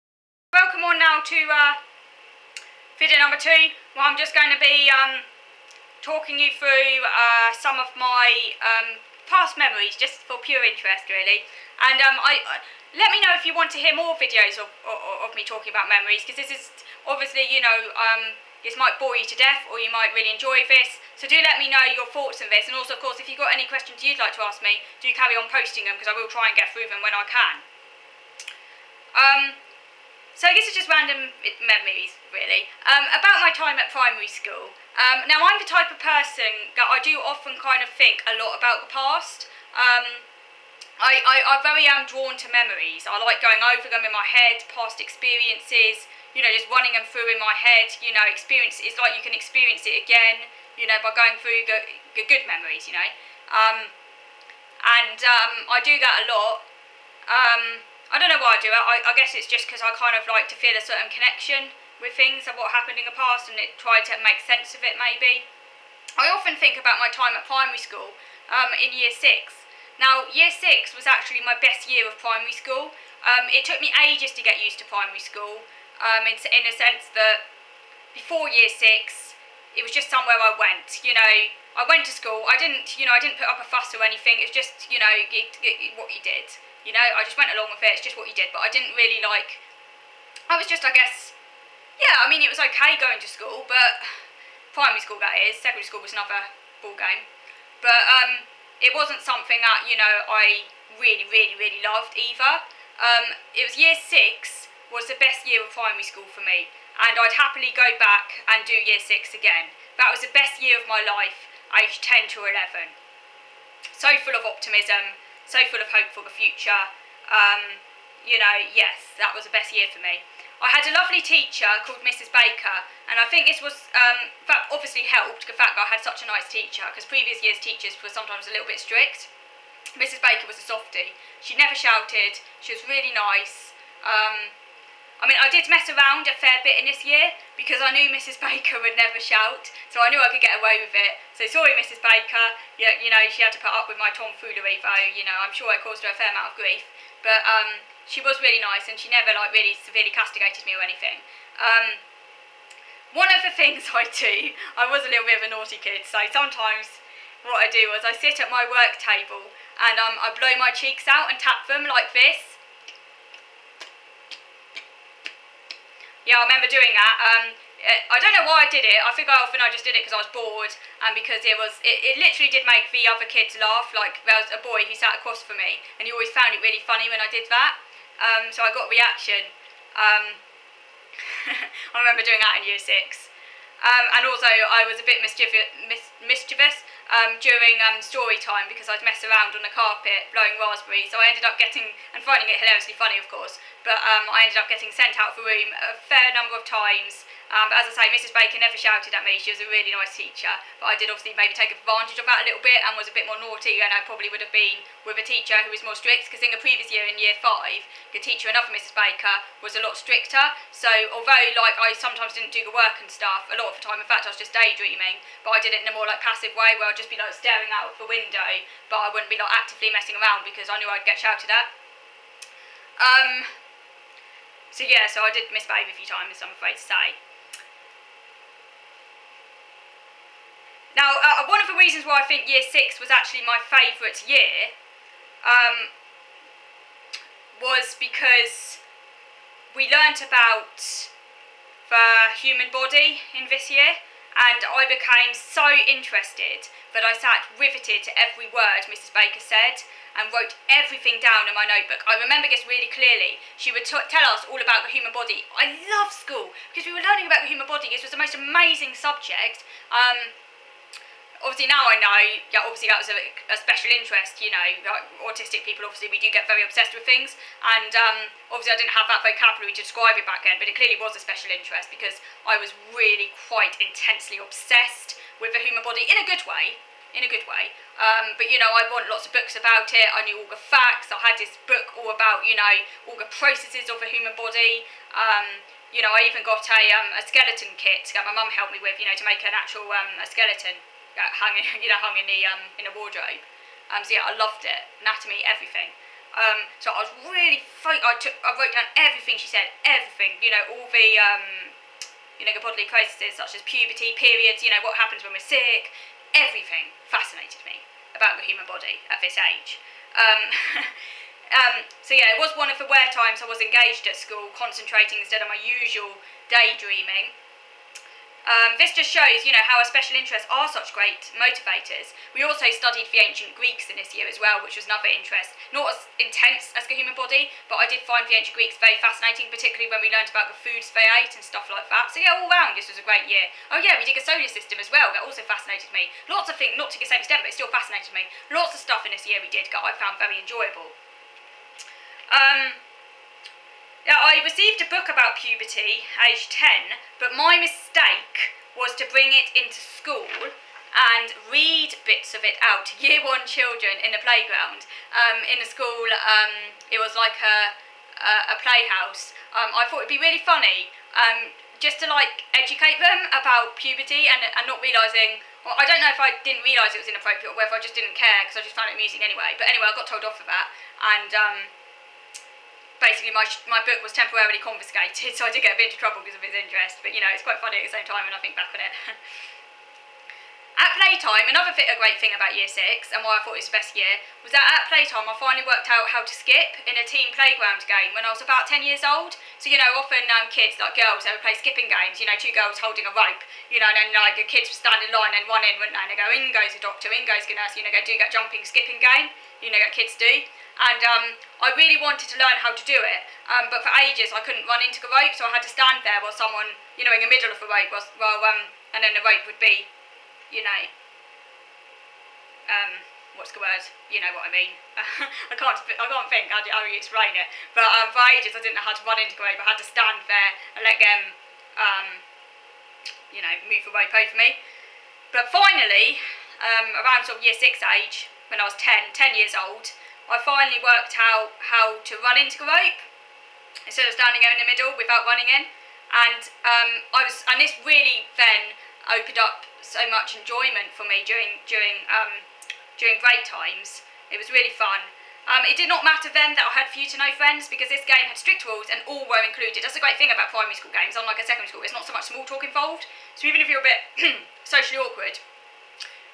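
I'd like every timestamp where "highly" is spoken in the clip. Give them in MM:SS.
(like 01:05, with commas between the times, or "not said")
not said.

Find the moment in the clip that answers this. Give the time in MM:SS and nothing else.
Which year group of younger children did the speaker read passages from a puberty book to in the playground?
05:52.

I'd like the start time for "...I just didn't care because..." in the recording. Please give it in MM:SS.
06:07.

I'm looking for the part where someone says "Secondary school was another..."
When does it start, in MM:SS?
01:35.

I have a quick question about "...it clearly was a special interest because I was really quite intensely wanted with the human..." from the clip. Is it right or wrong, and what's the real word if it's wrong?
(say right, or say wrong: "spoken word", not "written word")
wrong: "obsessed", not "wanted".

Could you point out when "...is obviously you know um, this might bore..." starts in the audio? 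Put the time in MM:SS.
00:16.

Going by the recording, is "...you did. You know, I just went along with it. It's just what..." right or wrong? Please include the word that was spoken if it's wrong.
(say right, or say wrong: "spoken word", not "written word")
right.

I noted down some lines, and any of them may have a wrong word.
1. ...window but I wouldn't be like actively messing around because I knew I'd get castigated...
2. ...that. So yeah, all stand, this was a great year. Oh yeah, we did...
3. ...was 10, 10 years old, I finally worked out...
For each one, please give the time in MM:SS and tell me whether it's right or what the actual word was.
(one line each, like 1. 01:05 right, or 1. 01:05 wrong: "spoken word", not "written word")
1. 03:38 wrong: "shouted", not "castigated"
2. 05:31 wrong: "round", not "stand"
3. 07:08 right.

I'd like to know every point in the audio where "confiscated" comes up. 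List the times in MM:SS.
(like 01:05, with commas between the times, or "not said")
06:14.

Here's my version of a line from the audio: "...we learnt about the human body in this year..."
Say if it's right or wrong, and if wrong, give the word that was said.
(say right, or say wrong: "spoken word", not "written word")
right.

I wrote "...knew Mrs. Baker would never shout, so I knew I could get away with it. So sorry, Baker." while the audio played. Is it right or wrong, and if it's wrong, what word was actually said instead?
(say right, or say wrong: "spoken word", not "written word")
wrong: "Mrs", not "Baker".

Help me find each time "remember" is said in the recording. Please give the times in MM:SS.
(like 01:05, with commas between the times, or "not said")
02:46, 03:01, 04:12.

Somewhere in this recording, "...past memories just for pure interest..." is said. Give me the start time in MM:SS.
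00:09.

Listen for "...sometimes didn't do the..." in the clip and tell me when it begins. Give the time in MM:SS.
03:31.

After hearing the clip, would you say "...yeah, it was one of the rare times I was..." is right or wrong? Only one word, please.
right.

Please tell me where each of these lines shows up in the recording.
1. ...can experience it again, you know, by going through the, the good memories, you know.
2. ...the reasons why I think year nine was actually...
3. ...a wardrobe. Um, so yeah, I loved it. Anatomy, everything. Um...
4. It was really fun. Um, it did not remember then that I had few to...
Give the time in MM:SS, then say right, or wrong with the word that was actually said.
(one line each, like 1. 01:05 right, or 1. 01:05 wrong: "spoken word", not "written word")
1. 00:49 right
2. 03:51 wrong: "six", not "nine"
3. 04:52 right
4. 07:24 wrong: "matter", not "remember".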